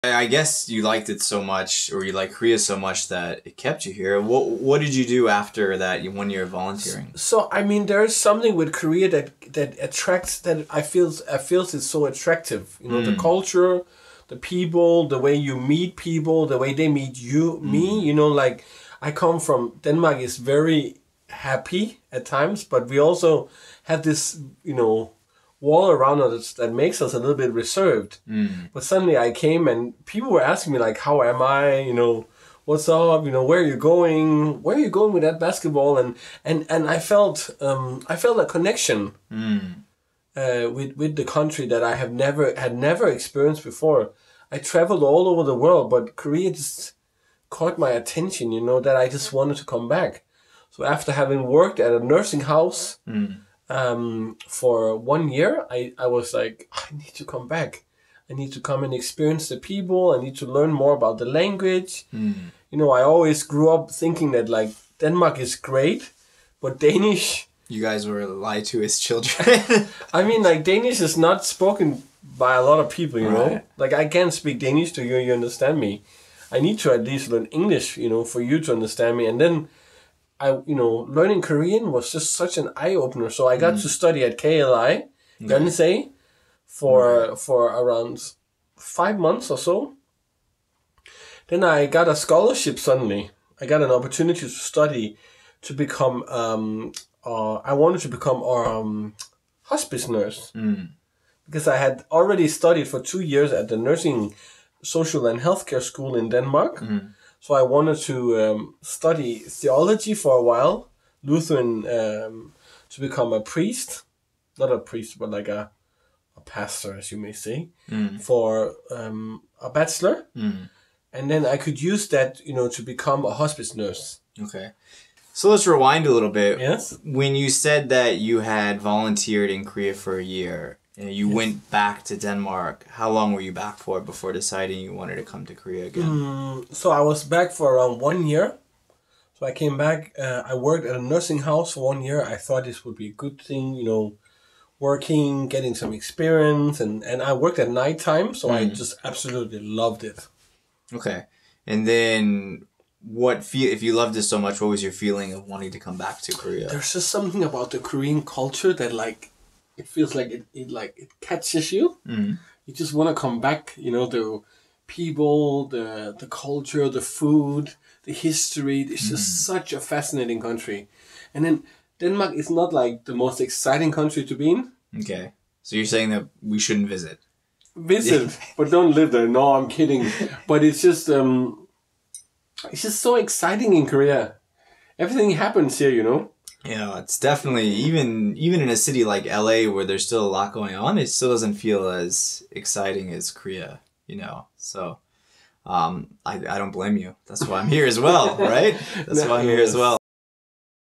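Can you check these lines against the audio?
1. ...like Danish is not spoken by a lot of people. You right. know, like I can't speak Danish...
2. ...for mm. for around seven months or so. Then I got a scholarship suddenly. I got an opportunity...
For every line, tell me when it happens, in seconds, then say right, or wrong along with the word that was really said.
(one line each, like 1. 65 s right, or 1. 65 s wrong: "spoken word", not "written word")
1. 70 s right
2. 86 s wrong: "five", not "seven".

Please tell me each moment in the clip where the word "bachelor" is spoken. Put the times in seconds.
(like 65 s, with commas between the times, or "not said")
119 s.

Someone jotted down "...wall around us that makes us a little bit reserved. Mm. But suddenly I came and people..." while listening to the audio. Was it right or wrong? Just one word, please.
right.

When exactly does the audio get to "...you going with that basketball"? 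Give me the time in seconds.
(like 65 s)
34 s.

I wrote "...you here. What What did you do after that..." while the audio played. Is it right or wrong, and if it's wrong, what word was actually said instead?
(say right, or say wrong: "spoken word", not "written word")
right.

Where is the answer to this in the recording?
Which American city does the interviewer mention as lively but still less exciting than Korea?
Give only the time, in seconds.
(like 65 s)
189 s.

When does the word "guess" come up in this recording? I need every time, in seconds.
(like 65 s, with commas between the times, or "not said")
0 s.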